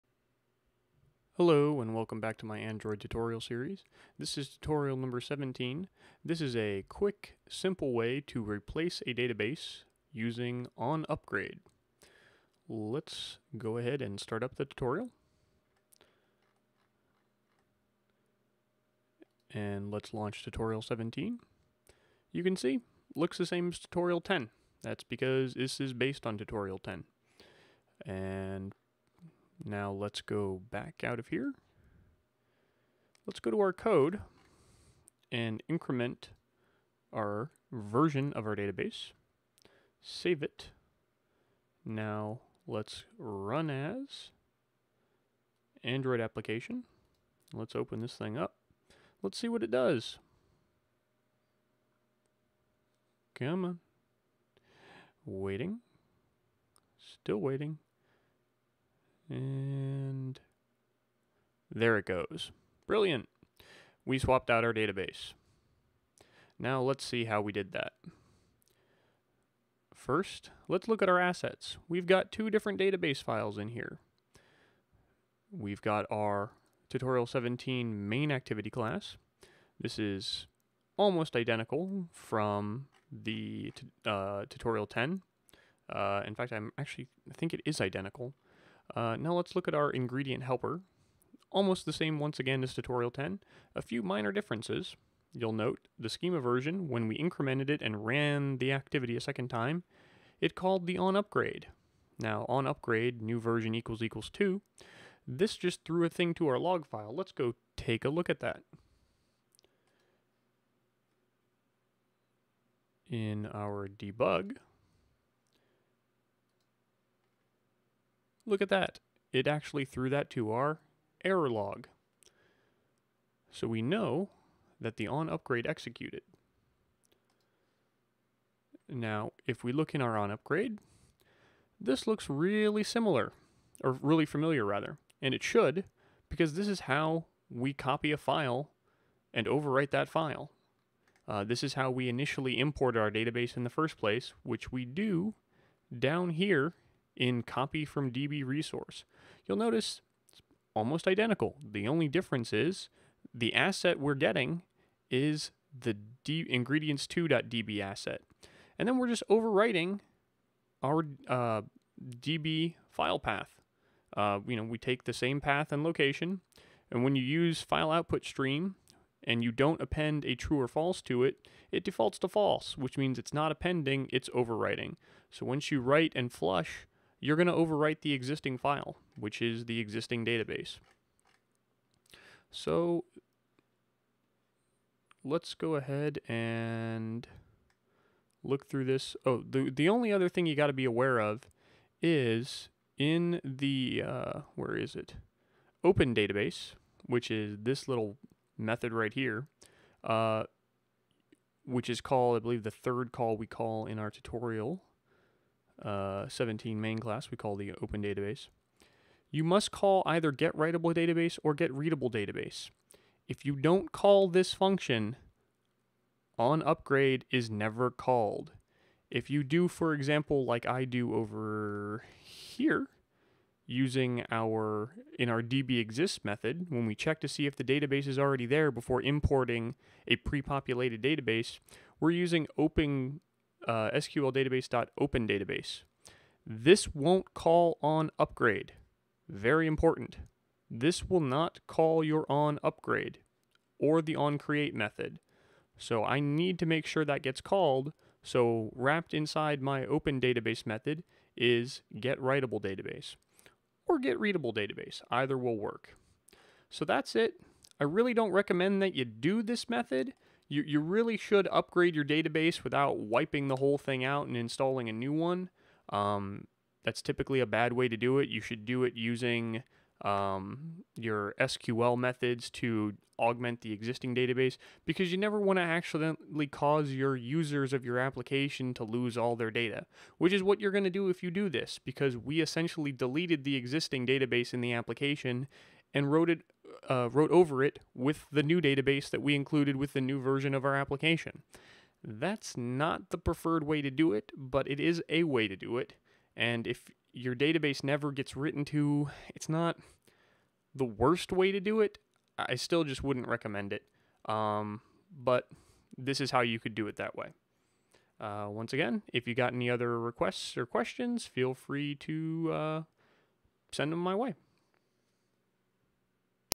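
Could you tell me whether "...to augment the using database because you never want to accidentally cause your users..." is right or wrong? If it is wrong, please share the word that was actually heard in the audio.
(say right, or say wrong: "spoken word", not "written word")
wrong: "existing", not "using".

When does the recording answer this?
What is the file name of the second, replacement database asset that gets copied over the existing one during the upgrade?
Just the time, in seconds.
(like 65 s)
156 s.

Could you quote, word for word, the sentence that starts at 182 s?
So let's go ahead and look through this.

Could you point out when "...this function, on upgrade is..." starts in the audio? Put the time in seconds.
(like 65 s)
214 s.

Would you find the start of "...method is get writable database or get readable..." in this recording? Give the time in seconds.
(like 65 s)
250 s.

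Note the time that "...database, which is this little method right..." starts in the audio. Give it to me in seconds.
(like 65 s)
196 s.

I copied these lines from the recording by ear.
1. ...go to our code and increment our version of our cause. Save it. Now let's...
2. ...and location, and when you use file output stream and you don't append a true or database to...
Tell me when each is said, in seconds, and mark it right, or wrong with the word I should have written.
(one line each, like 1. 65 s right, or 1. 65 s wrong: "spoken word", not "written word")
1. 33 s wrong: "database", not "cause"
2. 165 s wrong: "false", not "database".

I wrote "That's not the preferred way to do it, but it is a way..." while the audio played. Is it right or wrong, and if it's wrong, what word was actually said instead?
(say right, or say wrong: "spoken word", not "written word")
right.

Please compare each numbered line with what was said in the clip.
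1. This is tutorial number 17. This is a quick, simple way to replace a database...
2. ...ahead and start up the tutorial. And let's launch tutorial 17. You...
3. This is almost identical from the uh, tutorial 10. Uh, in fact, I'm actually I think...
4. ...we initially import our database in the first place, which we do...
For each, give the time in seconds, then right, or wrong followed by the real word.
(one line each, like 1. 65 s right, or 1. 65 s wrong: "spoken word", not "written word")
1. 4 s right
2. 13 s right
3. 79 s right
4. 141 s right.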